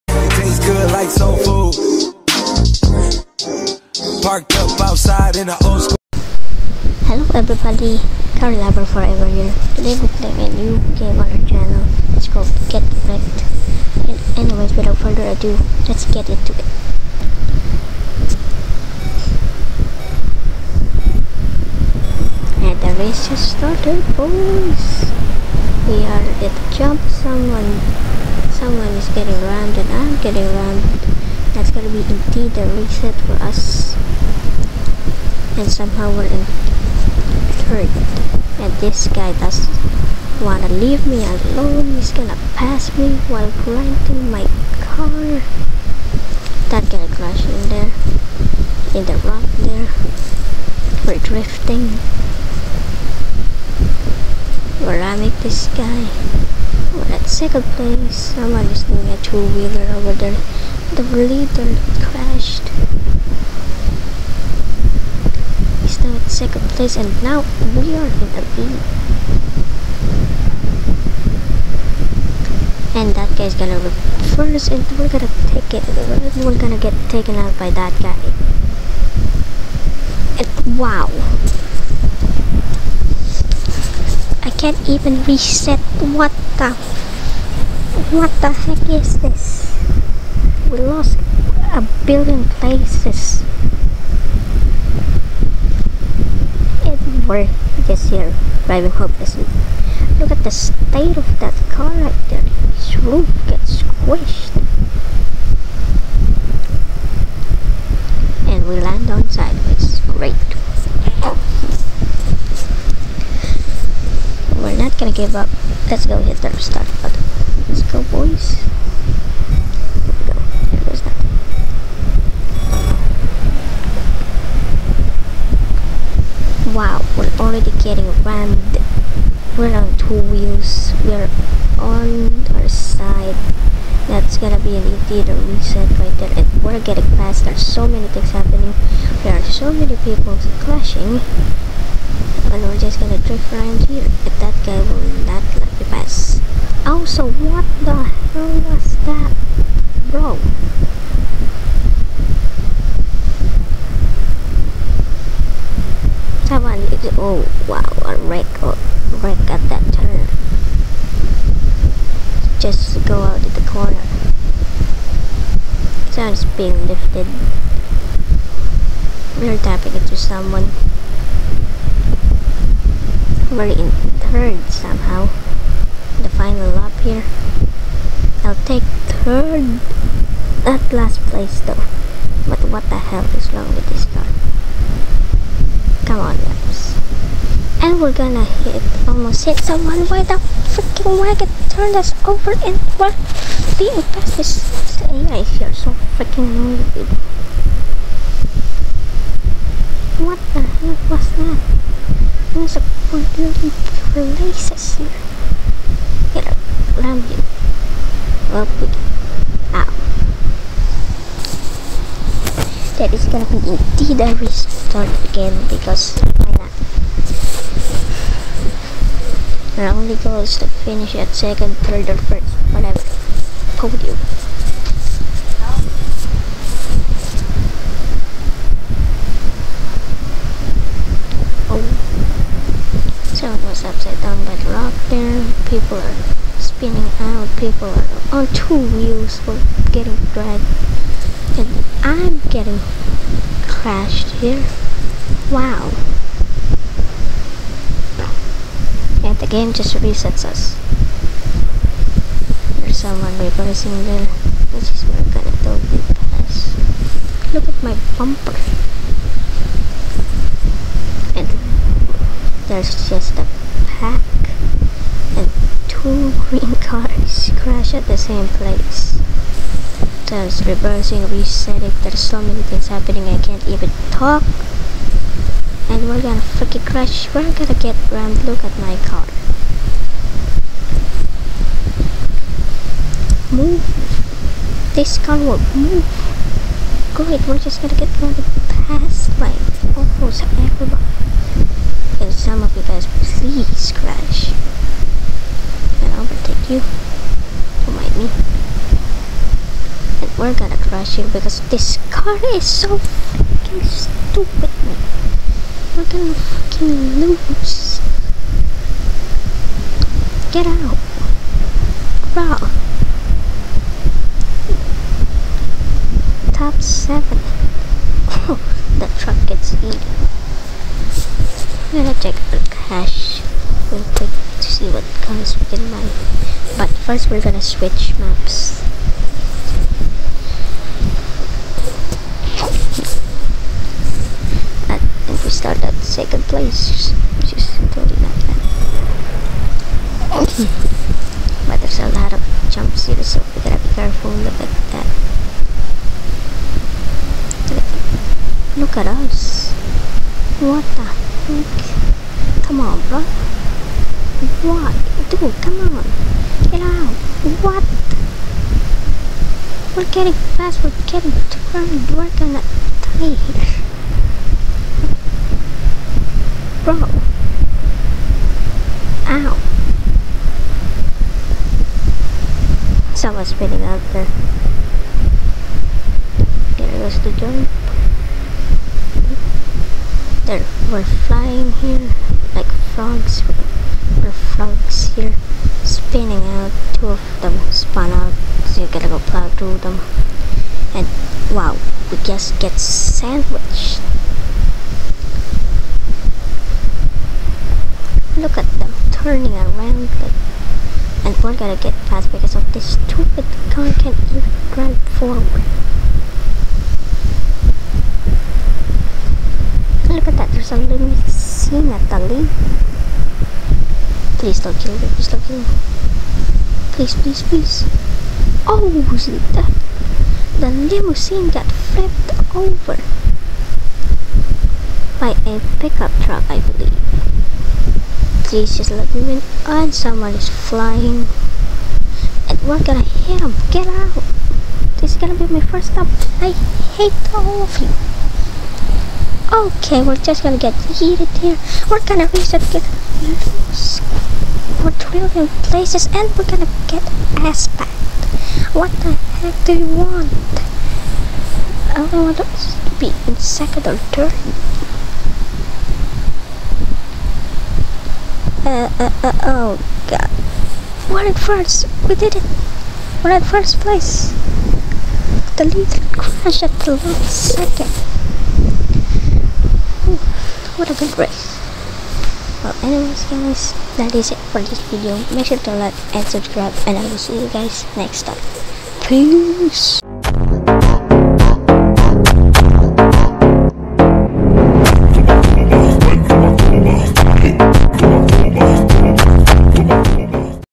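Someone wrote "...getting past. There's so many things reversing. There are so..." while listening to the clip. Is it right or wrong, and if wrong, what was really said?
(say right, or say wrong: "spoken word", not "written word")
wrong: "happening", not "reversing".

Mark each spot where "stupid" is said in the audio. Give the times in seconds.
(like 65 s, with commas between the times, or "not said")
303 s, 402 s.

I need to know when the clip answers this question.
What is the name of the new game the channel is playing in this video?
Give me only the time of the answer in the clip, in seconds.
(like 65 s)
12 s.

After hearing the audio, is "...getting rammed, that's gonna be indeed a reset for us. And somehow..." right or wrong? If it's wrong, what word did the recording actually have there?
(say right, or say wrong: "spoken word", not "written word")
right.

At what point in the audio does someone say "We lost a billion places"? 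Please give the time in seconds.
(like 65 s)
90 s.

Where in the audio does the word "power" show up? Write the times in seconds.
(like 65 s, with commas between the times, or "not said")
not said.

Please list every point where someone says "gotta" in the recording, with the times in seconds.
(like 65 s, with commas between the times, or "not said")
343 s, 388 s.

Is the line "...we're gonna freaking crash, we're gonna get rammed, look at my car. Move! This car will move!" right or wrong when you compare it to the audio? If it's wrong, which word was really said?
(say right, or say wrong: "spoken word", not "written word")
right.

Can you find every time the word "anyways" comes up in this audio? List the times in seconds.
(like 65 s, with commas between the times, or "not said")
14 s, 472 s.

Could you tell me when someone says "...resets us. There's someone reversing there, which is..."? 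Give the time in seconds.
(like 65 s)
249 s.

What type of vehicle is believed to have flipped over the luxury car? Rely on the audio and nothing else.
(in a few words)
pickup truck.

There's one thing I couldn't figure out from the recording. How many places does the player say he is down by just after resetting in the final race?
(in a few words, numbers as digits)
12.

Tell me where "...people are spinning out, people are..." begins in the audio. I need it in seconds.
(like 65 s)
235 s.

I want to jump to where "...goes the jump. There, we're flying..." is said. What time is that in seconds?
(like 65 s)
376 s.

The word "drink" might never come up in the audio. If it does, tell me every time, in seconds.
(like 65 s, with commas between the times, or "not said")
not said.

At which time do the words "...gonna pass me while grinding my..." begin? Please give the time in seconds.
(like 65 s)
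42 s.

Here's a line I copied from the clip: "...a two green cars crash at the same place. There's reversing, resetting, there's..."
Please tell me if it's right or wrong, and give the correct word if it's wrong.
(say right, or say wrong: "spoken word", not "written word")
right.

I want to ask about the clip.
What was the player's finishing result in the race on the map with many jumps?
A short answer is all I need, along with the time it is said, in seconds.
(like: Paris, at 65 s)
first place, at 463 s.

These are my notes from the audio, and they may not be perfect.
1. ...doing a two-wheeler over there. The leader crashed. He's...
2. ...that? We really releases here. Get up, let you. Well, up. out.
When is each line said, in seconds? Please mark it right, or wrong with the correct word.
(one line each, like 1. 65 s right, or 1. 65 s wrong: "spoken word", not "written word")
1. 58 s right
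2. 202 s right.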